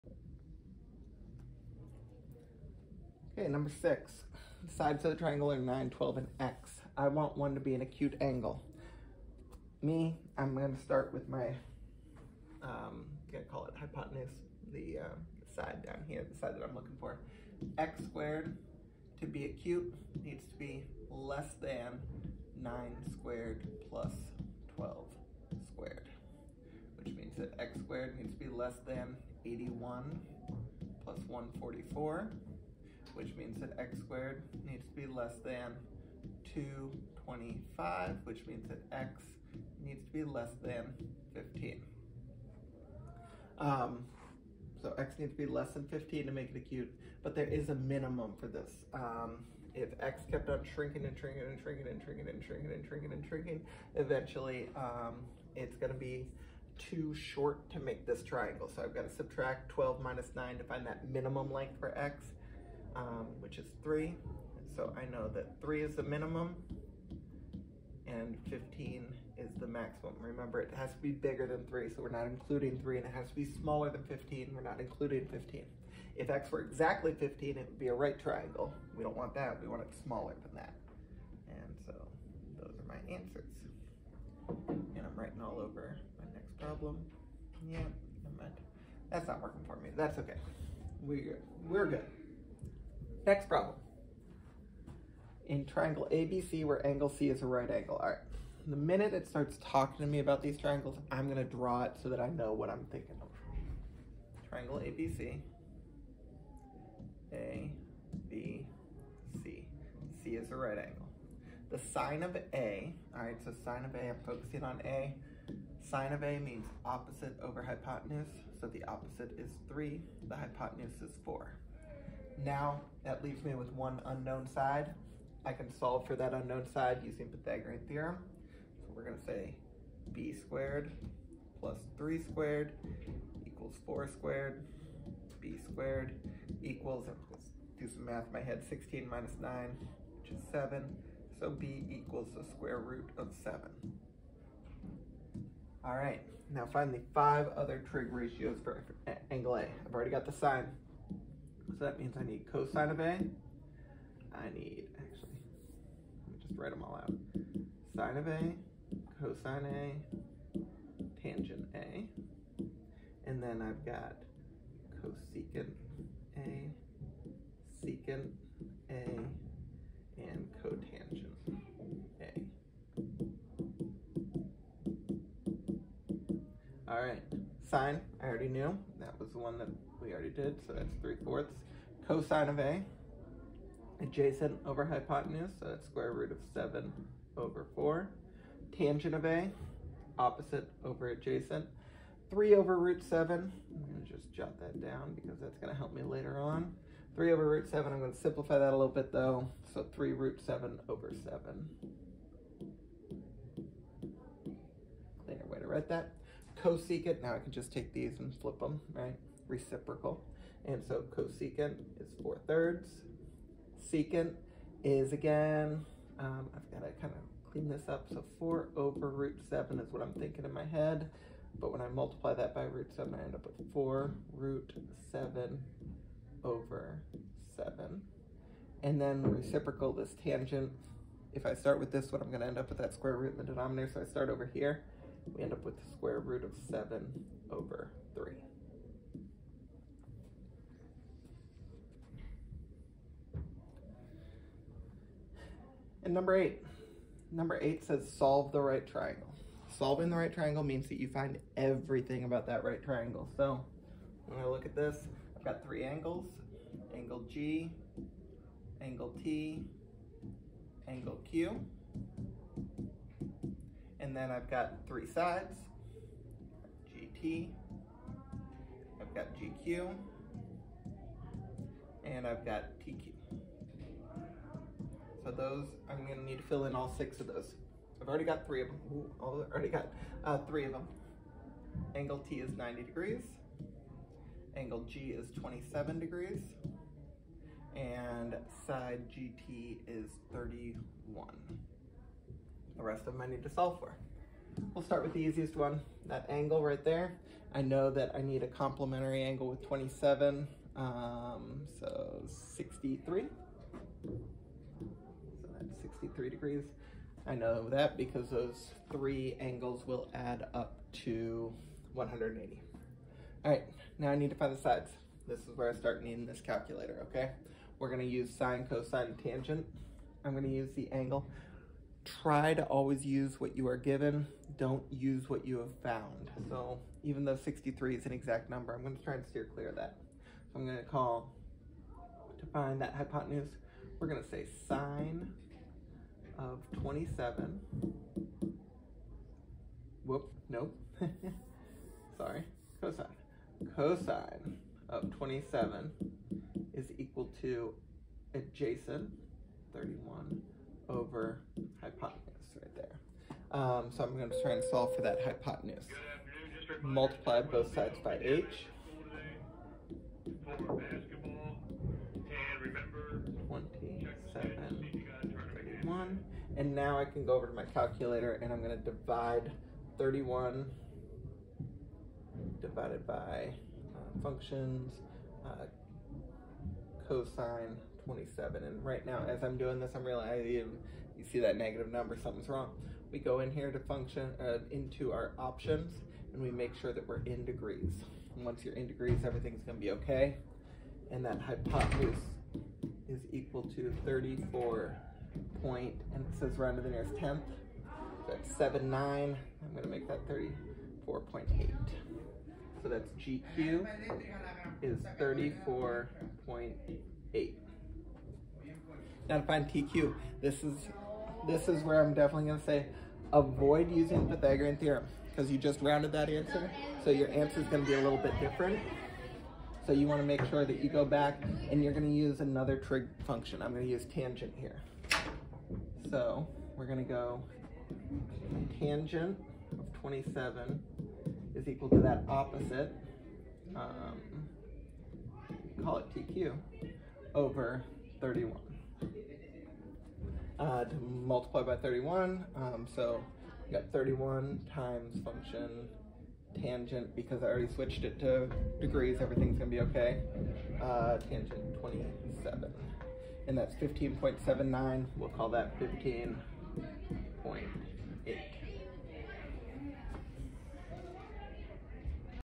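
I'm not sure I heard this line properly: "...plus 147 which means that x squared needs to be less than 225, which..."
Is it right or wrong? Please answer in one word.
wrong.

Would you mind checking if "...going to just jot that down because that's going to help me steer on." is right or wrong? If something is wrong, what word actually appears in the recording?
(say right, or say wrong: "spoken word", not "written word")
wrong: "later", not "steer".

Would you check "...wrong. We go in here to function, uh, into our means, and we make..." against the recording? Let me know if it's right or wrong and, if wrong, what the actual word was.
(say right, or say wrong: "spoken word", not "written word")
wrong: "options", not "means".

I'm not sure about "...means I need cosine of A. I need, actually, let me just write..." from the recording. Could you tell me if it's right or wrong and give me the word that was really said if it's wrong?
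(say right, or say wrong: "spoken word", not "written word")
right.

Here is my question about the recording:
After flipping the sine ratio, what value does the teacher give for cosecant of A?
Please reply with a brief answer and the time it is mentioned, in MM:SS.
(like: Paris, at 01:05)
4/3, at 03:31.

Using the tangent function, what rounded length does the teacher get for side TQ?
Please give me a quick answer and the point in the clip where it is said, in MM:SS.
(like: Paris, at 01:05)
15.8, at 07:35.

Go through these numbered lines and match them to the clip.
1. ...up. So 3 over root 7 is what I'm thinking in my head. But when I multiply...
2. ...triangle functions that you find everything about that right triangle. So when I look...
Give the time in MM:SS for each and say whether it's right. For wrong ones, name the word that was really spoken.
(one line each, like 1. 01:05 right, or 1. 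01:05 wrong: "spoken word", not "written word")
1. 03:37 wrong: "4", not "3"
2. 04:10 wrong: "means", not "functions".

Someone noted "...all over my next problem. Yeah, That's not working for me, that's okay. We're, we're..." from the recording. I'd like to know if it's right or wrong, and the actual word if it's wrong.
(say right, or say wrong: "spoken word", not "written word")
right.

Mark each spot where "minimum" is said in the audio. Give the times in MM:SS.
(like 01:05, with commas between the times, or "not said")
00:47, 01:01, 01:06.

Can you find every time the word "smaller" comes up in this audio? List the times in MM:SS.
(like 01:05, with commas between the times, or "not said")
01:13, 01:20.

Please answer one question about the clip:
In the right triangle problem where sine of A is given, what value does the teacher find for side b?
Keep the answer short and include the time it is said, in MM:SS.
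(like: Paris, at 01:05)
square root of 7, at 02:21.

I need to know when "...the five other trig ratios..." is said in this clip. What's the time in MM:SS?
02:26.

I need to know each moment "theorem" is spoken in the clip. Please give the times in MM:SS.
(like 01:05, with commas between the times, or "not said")
02:07, 06:54.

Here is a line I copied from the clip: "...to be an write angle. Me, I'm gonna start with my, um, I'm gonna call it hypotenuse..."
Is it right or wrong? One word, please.
wrong.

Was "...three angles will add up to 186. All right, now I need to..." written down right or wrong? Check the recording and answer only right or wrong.
wrong.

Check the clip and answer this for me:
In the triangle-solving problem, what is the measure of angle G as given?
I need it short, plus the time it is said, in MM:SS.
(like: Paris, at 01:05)
27 degrees, at 04:44.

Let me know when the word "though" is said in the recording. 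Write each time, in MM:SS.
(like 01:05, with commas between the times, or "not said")
03:19, 05:27.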